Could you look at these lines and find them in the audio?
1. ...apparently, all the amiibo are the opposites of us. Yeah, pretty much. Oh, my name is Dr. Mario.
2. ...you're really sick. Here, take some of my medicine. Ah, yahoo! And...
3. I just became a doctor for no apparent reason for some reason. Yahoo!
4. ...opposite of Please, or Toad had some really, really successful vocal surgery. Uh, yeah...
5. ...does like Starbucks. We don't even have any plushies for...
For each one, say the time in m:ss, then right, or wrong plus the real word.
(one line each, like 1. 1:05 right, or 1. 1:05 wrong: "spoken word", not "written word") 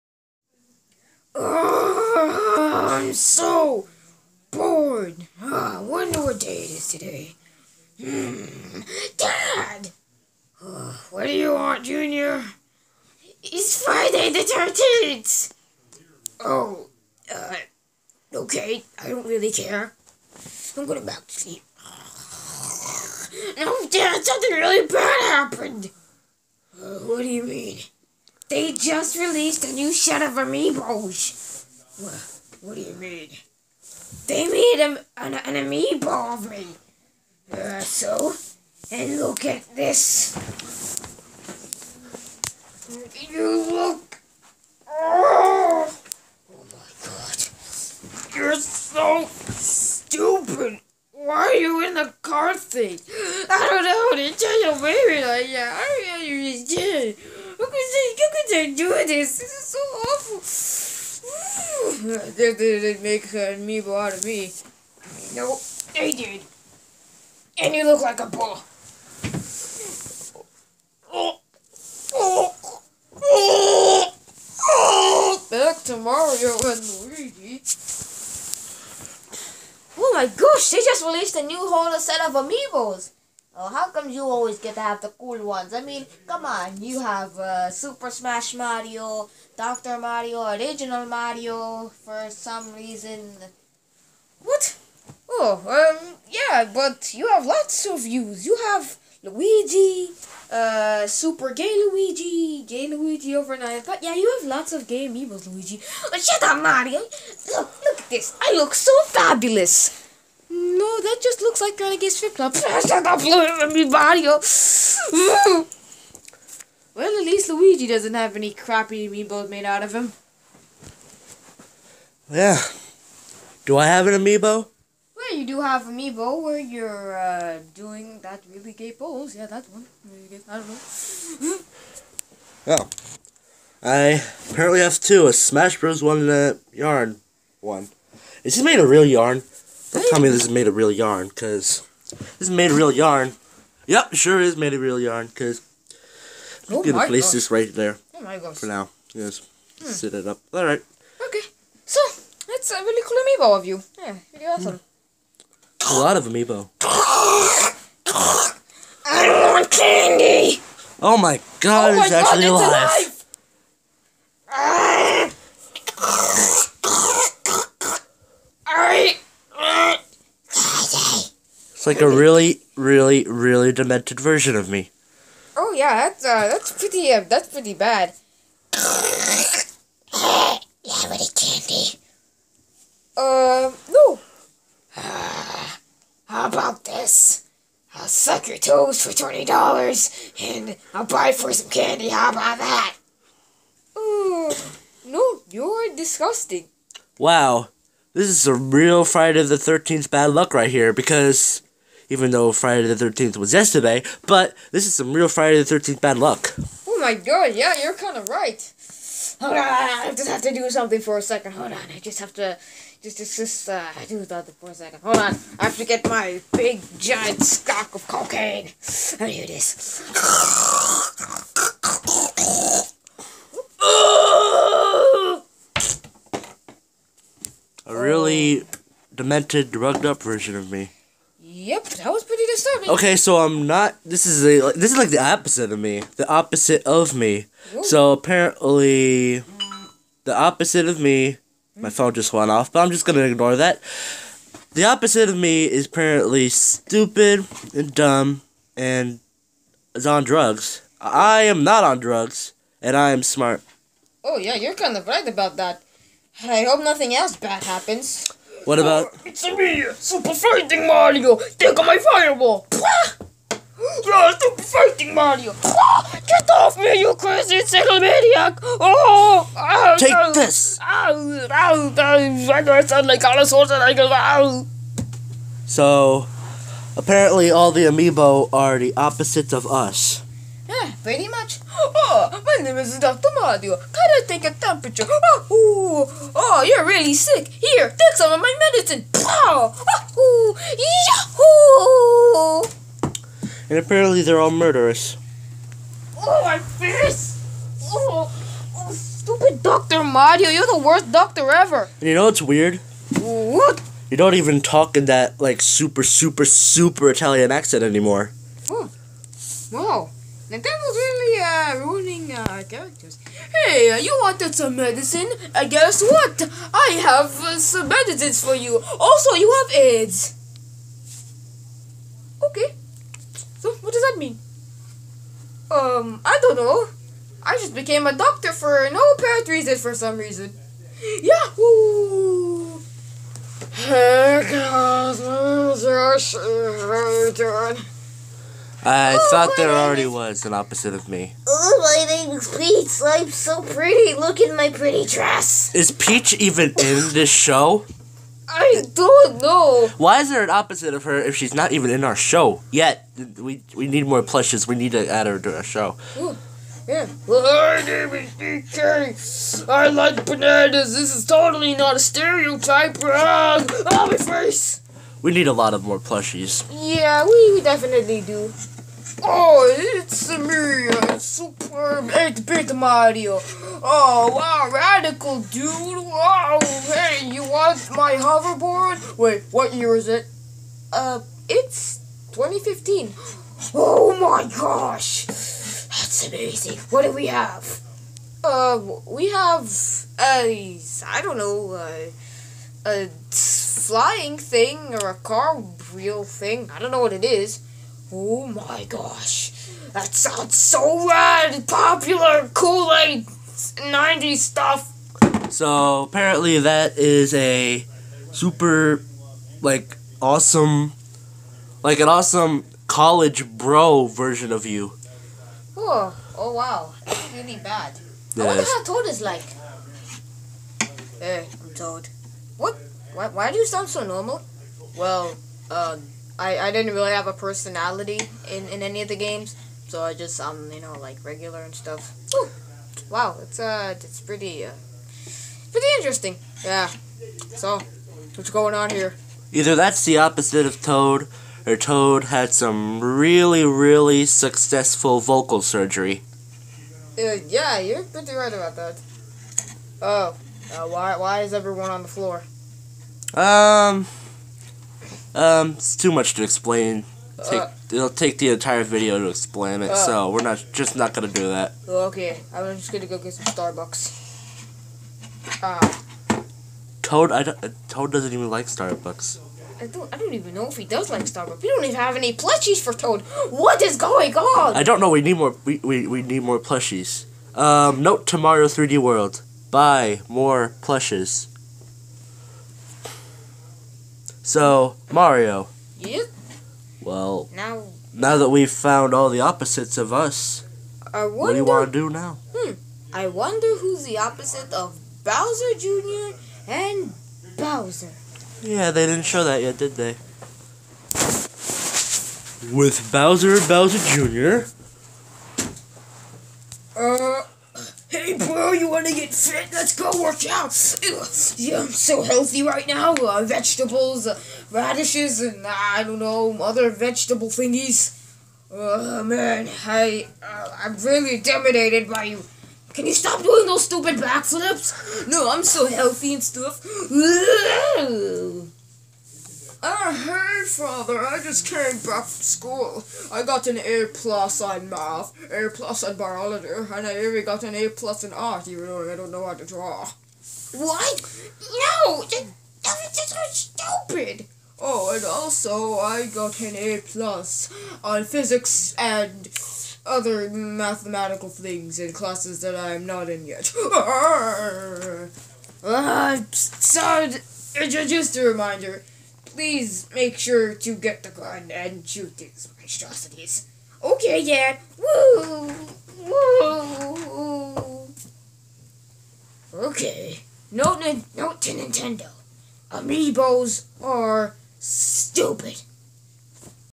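1. 4:36 right
2. 4:46 right
3. 5:27 right
4. 7:20 wrong: "Toad", not "Please"
5. 7:50 right.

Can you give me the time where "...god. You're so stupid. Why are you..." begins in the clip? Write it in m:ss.
0:47.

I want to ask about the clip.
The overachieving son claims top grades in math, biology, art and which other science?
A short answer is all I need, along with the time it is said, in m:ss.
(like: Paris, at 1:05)
Physics, at 9:08.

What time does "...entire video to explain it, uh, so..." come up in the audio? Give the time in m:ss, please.
7:38.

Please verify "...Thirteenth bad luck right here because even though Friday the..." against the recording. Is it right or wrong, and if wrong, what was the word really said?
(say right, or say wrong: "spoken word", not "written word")
right.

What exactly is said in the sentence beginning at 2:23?
Yep, sure is made of real yarn, because Oh gonna place this right there.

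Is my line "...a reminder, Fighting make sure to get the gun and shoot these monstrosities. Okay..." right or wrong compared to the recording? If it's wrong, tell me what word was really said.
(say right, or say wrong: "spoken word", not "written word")
wrong: "Please", not "Fighting".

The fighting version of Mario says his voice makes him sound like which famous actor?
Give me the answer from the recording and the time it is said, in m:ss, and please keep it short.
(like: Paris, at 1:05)
Arnold Schwarzenegger, at 4:33.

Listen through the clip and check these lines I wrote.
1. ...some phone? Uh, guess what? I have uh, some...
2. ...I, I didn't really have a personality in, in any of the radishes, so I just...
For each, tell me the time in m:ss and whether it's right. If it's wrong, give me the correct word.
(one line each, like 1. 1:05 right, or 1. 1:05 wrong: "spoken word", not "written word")
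1. 5:14 wrong: "medicine", not "phone"
2. 7:06 wrong: "games", not "radishes".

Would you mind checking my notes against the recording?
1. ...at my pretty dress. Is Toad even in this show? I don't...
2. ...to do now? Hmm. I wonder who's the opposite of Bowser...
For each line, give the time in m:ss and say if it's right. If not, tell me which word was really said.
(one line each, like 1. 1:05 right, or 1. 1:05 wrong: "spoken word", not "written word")
1. 5:44 wrong: "Peach", not "Toad"
2. 8:11 right.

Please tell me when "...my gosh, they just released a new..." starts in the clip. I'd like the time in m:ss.
1:20.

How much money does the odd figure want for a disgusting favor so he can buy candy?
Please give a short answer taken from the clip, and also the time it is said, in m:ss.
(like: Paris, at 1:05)
$20, at 3:09.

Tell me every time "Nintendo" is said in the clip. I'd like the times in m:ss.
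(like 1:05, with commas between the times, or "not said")
5:10, 9:31.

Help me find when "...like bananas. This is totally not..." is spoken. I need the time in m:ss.
5:59.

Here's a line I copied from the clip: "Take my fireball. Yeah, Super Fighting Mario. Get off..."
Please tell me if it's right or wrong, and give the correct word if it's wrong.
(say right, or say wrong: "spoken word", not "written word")
right.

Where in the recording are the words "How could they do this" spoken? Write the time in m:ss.
0:57.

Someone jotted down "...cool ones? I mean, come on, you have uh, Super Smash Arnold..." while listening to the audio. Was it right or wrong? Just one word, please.
wrong.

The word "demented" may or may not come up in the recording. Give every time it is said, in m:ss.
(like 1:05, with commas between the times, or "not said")
2:53, 3:49.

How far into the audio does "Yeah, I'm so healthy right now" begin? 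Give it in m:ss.
8:31.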